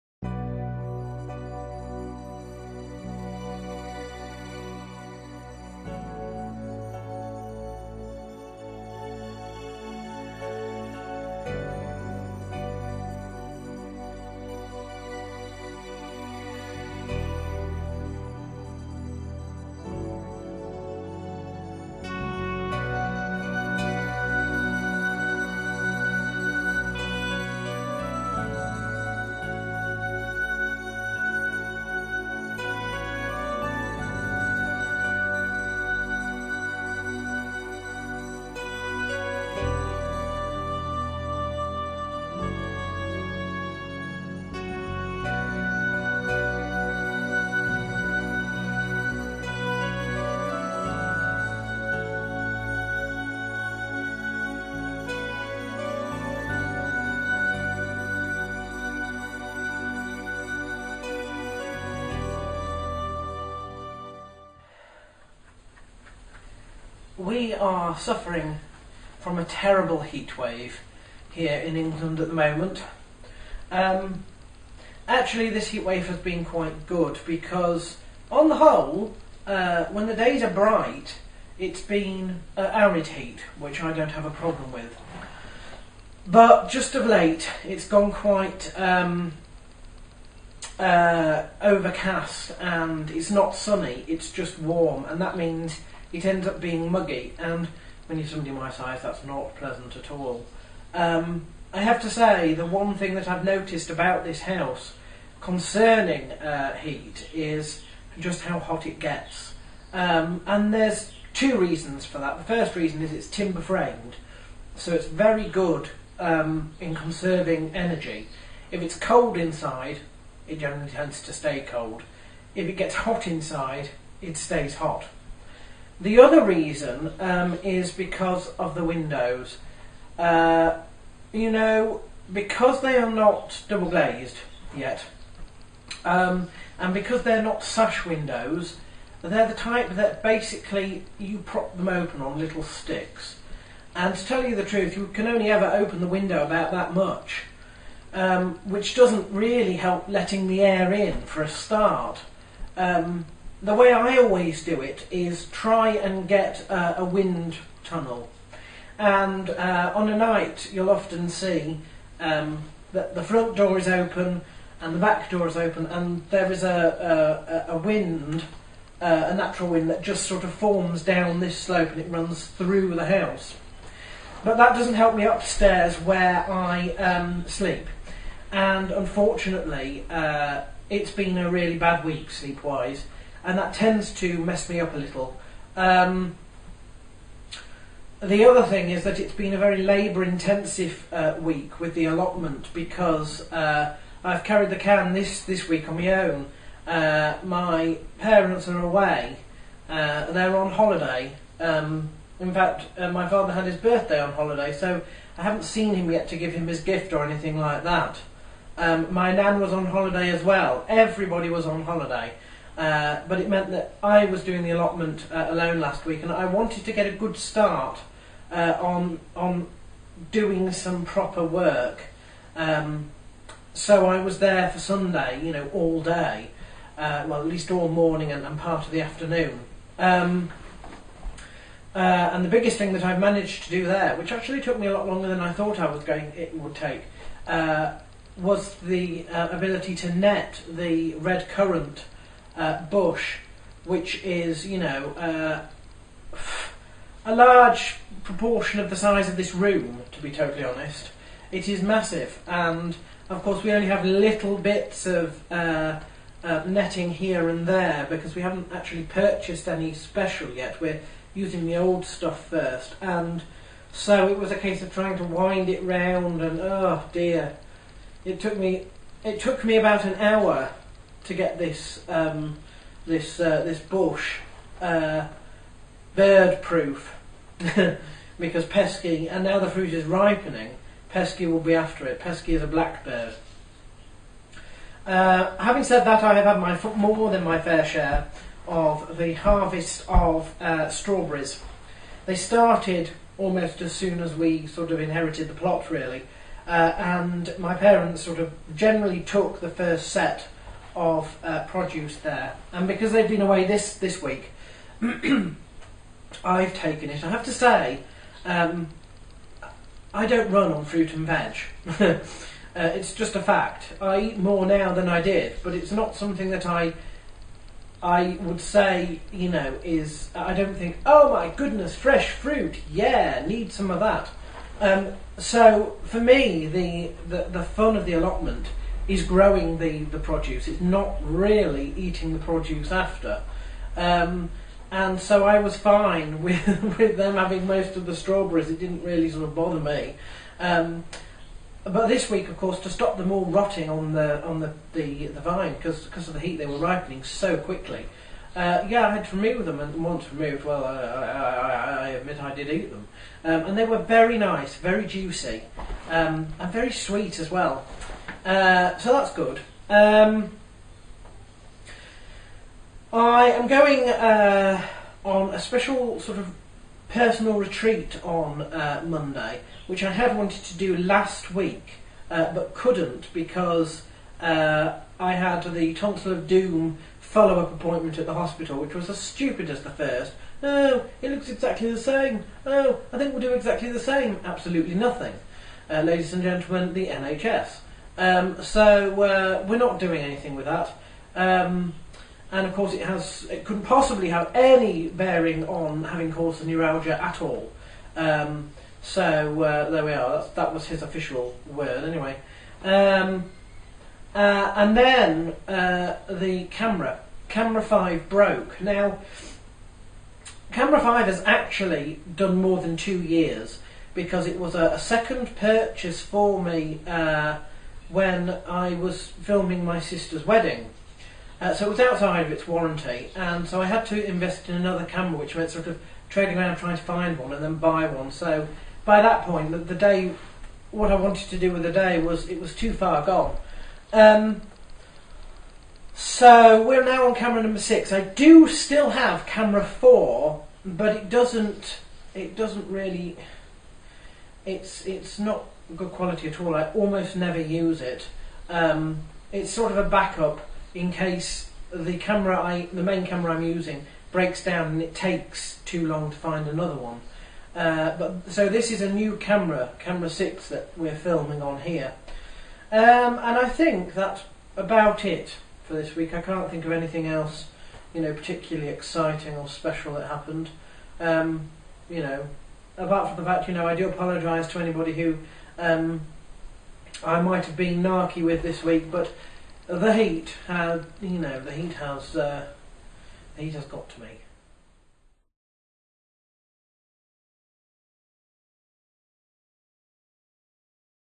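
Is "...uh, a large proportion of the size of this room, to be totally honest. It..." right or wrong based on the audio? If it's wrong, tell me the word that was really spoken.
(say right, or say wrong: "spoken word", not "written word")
right.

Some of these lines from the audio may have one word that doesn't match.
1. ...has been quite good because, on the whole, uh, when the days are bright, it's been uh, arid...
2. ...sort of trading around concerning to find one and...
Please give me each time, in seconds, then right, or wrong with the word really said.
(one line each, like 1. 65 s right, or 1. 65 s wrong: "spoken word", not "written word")
1. 76 s right
2. 425 s wrong: "trying", not "concerning".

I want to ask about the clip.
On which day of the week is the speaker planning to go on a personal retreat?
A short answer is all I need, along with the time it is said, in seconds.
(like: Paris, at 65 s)
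Monday, at 369 s.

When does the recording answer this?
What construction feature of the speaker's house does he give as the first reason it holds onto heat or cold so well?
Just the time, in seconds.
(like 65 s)
113 s.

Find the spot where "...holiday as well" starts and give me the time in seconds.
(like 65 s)
209 s.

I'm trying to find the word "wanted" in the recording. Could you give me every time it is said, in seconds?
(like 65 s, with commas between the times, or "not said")
216 s, 370 s, 431 s.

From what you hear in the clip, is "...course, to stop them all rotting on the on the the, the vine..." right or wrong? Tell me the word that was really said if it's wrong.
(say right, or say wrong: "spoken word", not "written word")
right.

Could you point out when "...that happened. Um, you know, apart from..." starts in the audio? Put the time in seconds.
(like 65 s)
470 s.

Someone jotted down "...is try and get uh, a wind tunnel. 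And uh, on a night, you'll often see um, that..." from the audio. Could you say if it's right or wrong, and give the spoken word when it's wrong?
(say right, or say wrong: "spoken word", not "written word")
right.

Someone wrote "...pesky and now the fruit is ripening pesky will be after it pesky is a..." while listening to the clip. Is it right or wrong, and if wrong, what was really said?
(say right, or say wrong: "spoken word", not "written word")
right.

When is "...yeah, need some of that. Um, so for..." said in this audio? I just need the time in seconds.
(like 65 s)
322 s.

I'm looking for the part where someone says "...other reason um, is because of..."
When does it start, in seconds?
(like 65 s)
126 s.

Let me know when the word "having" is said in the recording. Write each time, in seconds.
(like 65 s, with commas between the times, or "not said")
285 s, 337 s, 396 s.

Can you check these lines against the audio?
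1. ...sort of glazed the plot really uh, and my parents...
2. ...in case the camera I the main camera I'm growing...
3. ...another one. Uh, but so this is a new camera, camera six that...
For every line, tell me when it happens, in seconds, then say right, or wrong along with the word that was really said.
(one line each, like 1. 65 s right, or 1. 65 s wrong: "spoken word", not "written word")
1. 294 s wrong: "inherited", not "glazed"
2. 450 s wrong: "using", not "growing"
3. 456 s right.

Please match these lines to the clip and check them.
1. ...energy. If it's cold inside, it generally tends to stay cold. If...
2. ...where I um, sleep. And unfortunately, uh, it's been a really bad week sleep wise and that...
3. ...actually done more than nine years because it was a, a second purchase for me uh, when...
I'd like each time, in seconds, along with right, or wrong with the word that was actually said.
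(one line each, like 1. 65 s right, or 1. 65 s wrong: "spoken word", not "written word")
1. 117 s right
2. 175 s right
3. 411 s wrong: "two", not "nine".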